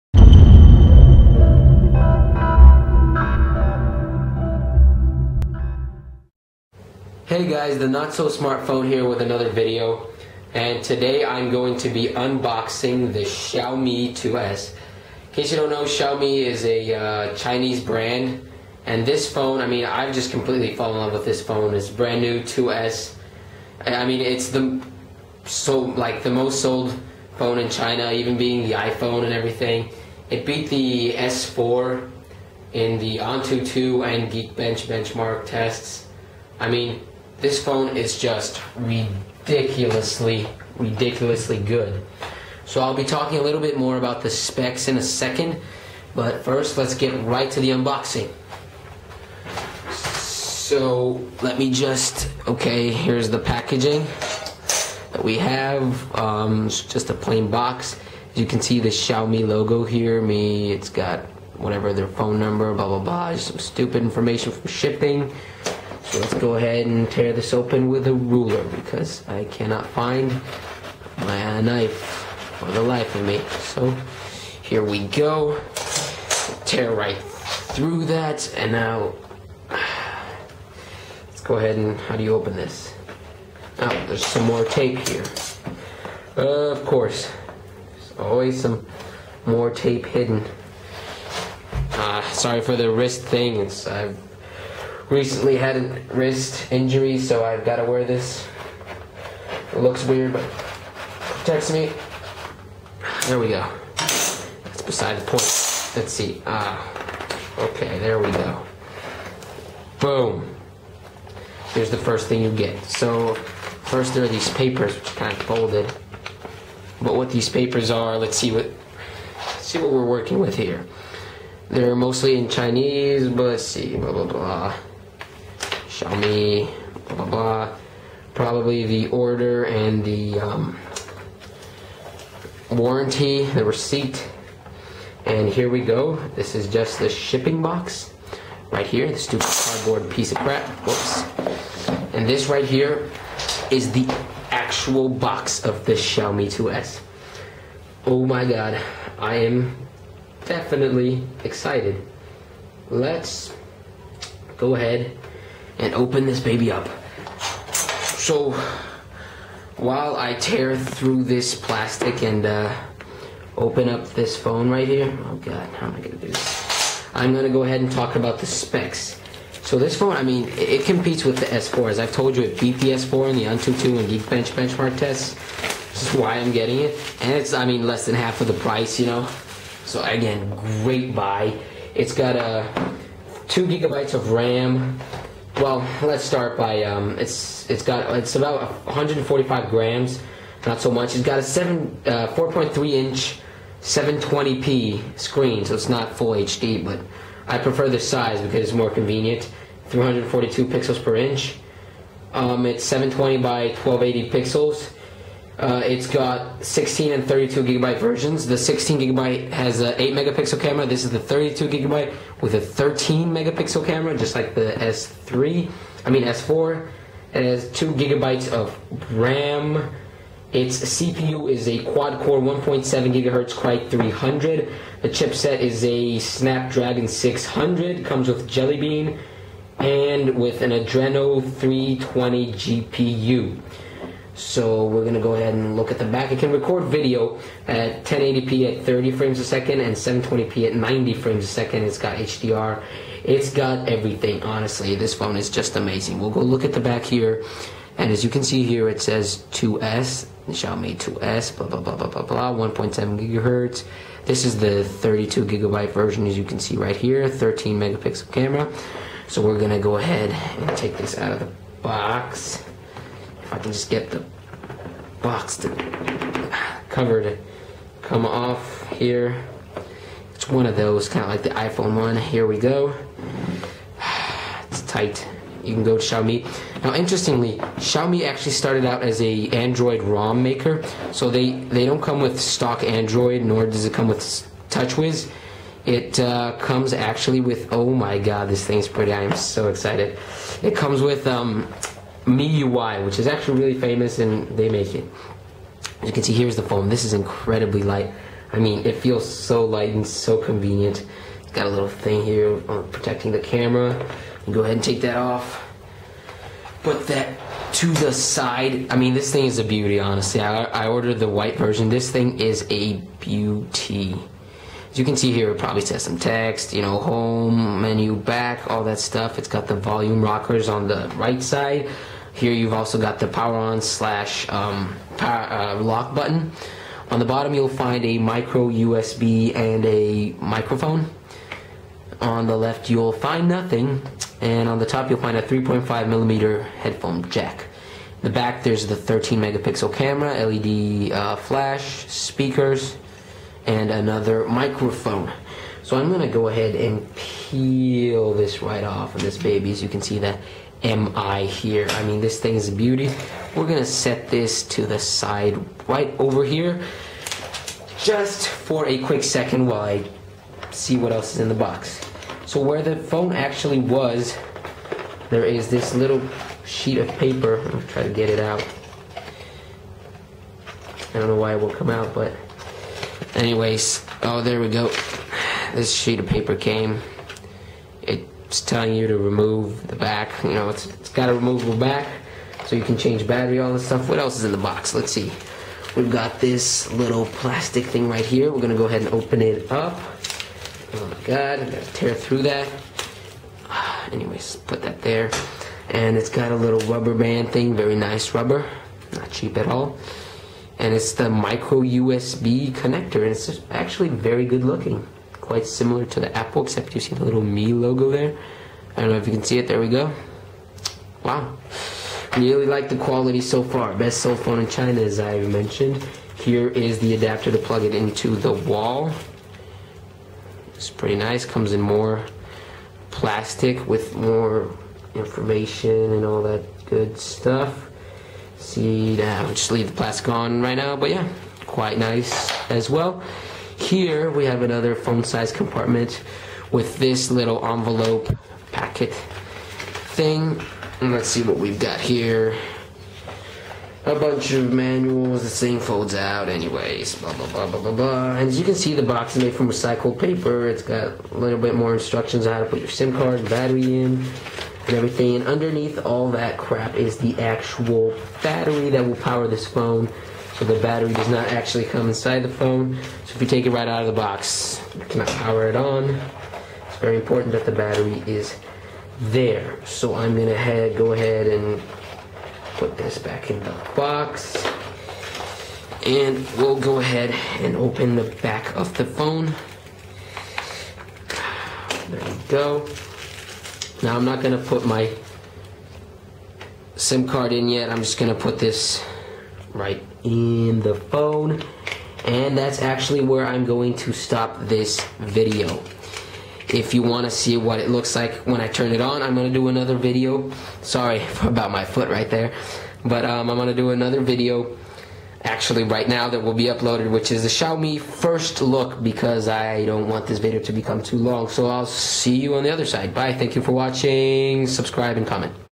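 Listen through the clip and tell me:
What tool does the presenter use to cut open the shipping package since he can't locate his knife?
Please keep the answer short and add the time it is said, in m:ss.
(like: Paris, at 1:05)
ruler, at 1:08.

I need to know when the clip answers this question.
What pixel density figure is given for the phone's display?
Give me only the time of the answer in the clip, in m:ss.
3:19.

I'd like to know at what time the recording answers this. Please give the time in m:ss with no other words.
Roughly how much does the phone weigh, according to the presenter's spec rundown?
3:08.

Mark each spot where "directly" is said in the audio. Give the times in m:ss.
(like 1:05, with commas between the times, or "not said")
not said.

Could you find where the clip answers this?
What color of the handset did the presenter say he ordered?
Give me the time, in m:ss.
5:11.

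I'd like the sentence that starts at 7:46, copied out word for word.
It's very important that the battery is there.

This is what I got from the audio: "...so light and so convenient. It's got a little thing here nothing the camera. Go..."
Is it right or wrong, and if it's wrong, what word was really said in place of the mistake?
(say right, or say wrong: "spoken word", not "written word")
wrong: "protecting", not "nothing".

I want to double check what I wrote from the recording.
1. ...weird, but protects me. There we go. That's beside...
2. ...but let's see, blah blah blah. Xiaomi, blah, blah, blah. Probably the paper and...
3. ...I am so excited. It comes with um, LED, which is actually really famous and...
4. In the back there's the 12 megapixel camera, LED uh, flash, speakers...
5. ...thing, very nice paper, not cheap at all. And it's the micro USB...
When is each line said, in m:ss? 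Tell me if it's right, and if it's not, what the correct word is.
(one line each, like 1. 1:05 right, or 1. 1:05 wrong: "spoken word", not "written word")
1. 1:40 right
2. 2:03 wrong: "order", not "paper"
3. 4:49 wrong: "MIUI", not "LED"
4. 5:38 wrong: "13", not "12"
5. 6:37 wrong: "rubber", not "paper".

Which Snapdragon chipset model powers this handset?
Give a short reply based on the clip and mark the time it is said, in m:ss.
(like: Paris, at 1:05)
Snapdragon 600, at 3:46.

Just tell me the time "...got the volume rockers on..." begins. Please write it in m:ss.
5:19.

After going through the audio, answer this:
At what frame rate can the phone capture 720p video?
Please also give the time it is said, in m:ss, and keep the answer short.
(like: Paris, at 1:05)
90 frames a second, at 4:00.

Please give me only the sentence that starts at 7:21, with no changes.
And let's see what we've got here.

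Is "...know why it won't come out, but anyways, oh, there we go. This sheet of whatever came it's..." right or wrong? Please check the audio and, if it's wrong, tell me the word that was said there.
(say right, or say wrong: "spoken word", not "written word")
wrong: "paper", not "whatever".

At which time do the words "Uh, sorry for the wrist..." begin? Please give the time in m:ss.
1:31.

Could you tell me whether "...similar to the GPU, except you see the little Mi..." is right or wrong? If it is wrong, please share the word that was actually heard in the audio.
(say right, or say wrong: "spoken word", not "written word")
wrong: "Apple", not "GPU".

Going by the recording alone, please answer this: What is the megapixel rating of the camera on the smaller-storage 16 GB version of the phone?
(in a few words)
8 megapixel.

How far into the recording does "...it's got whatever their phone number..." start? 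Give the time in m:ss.
1:00.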